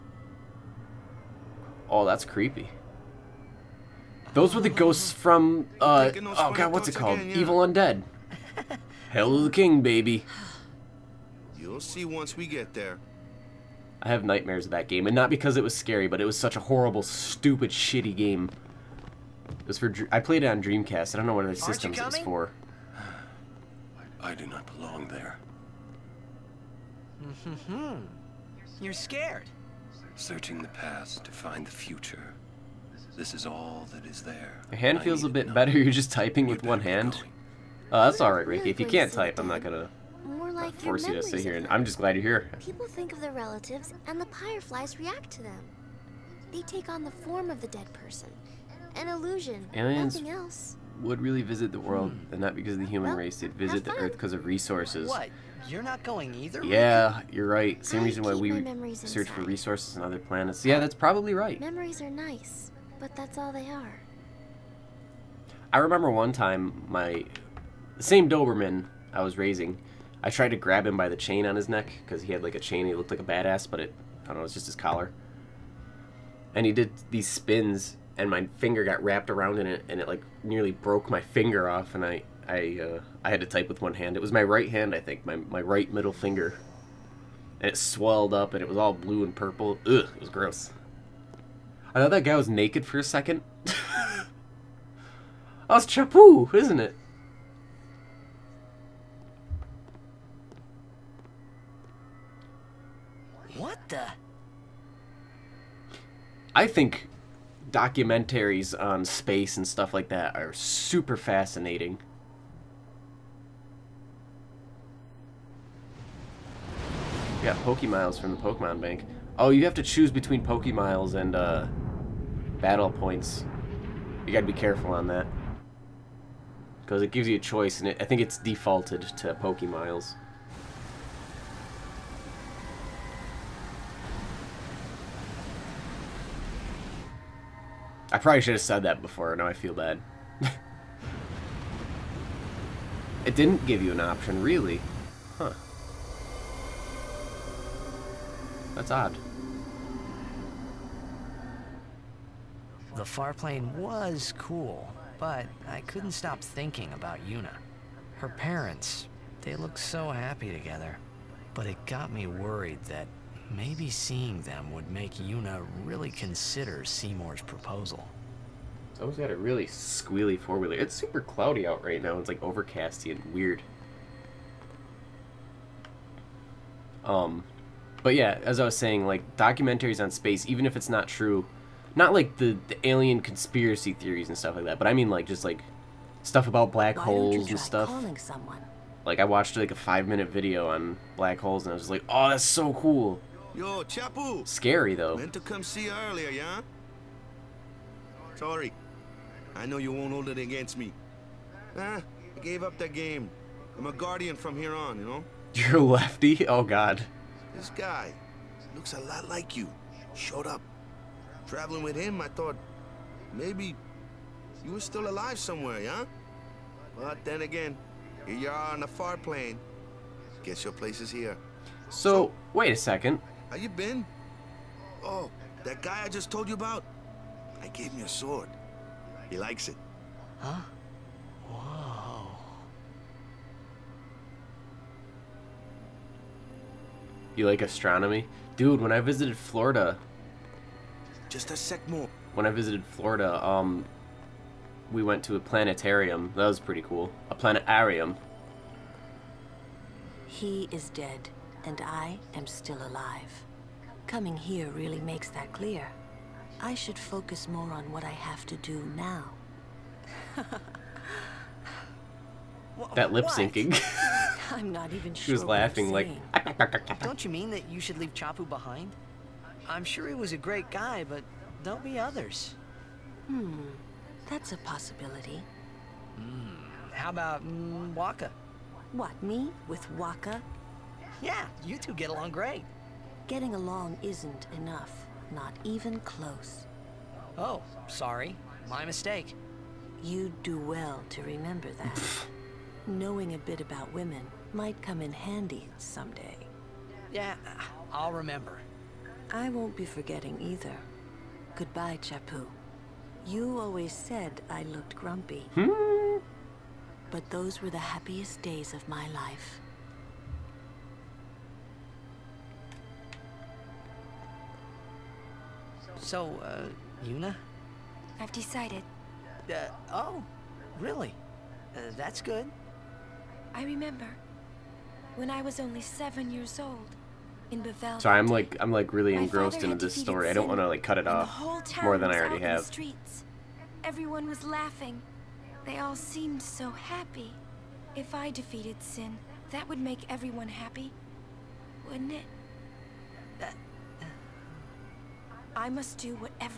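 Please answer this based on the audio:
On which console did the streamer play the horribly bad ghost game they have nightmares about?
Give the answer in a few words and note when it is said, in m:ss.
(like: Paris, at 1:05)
Dreamcast, at 0:20.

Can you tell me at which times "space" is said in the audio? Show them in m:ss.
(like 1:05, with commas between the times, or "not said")
1:49, 3:00.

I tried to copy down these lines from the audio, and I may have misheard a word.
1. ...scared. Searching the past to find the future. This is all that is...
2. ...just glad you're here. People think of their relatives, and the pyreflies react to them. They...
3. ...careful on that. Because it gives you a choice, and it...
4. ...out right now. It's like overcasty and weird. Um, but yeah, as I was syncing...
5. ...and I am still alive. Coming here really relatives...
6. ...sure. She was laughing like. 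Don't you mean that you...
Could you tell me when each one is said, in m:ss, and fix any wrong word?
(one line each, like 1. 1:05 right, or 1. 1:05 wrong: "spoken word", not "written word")
1. 0:28 right
2. 0:41 right
3. 2:04 right
4. 2:51 wrong: "saying", not "syncing"
5. 4:11 wrong: "makes", not "relatives"
6. 4:25 right.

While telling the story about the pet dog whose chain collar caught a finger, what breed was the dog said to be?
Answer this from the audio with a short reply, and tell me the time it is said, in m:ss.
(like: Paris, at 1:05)
Doberman, at 1:08.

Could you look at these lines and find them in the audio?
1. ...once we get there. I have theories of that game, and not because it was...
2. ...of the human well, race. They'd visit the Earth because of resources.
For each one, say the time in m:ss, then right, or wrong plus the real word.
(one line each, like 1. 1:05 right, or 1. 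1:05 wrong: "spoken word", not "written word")
1. 0:12 wrong: "nightmares", not "theories"
2. 0:52 right.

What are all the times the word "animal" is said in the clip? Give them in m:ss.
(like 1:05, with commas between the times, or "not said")
not said.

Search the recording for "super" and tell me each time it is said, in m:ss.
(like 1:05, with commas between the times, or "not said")
1:50, 2:50.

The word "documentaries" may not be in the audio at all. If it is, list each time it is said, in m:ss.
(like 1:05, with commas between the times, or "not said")
1:47, 2:59.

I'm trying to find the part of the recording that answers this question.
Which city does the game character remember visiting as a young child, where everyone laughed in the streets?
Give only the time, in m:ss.
5:27.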